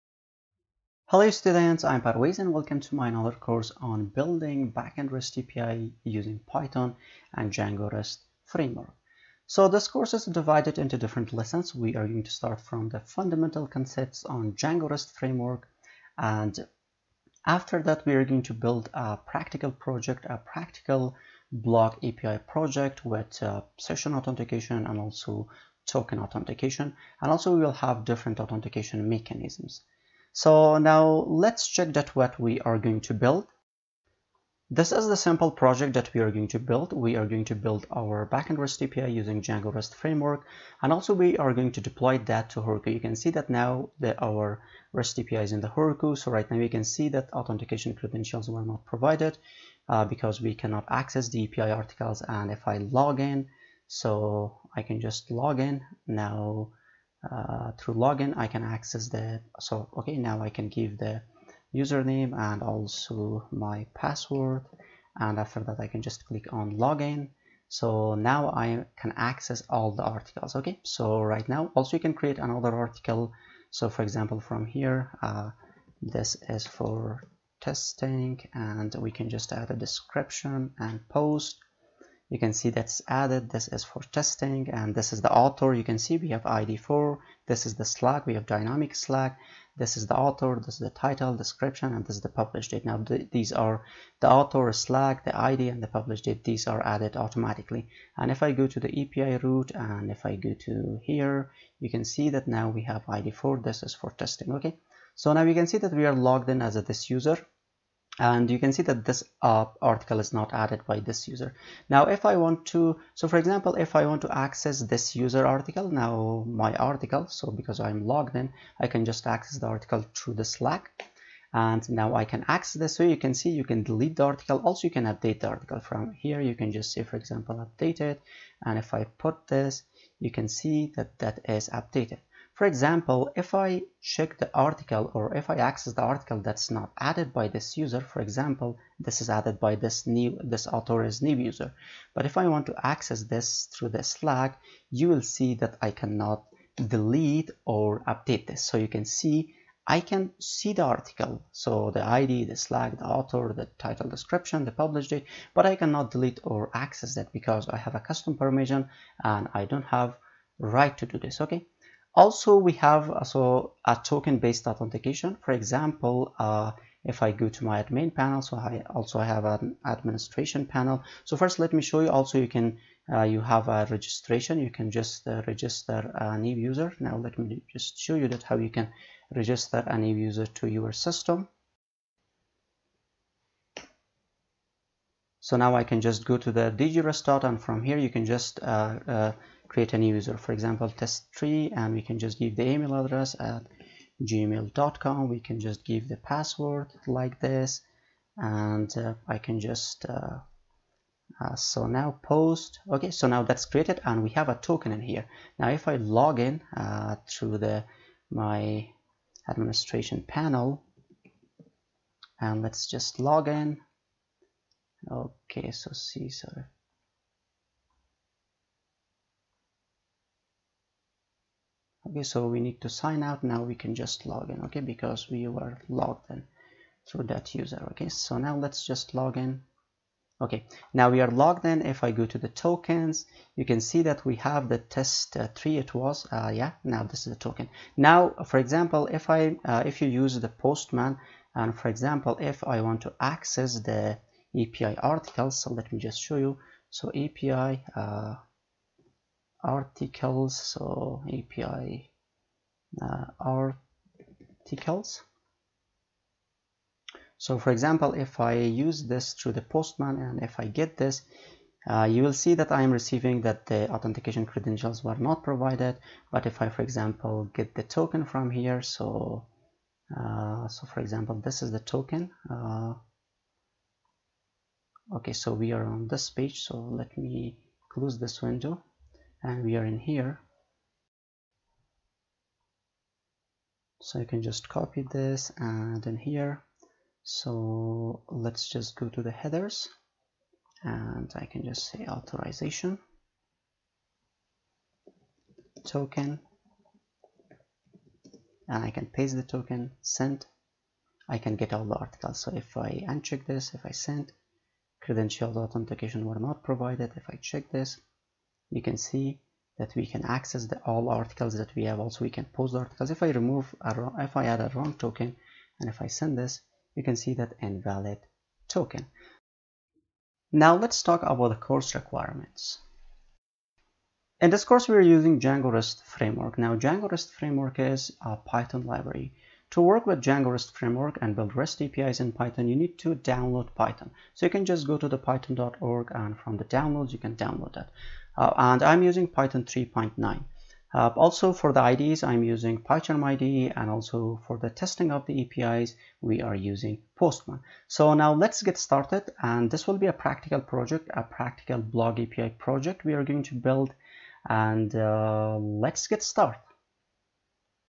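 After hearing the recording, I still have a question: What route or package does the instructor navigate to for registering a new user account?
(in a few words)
dj-rest-auth.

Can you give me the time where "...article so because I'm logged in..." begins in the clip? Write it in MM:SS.
01:56.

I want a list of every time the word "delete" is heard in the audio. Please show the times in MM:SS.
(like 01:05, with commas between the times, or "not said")
02:03, 02:26, 02:36.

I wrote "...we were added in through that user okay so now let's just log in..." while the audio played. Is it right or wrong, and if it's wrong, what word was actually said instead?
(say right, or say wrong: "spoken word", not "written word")
wrong: "logged", not "added".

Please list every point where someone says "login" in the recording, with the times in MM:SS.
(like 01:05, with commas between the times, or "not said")
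00:57, 01:06.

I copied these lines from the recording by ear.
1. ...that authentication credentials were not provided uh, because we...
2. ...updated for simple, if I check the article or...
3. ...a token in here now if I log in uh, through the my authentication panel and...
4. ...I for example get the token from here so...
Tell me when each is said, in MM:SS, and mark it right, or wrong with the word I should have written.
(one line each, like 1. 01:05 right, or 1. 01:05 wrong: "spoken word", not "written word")
1. 00:47 right
2. 02:11 wrong: "example", not "simple"
3. 03:24 wrong: "administration", not "authentication"
4. 04:26 right.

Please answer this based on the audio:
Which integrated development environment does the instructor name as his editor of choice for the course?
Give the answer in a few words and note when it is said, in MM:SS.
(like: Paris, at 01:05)
PyCharm, at 05:42.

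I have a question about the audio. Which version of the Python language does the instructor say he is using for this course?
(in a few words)
Python 3.9.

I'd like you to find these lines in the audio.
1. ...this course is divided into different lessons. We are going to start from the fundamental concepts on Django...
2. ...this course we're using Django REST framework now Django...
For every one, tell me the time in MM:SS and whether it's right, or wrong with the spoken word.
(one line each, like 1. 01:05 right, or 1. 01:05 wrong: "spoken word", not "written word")
1. 00:09 right
2. 05:24 right.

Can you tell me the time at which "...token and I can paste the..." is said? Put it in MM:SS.
04:55.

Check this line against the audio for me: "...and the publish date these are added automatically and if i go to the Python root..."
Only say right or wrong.
wrong.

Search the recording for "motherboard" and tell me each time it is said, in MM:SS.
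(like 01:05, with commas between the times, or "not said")
not said.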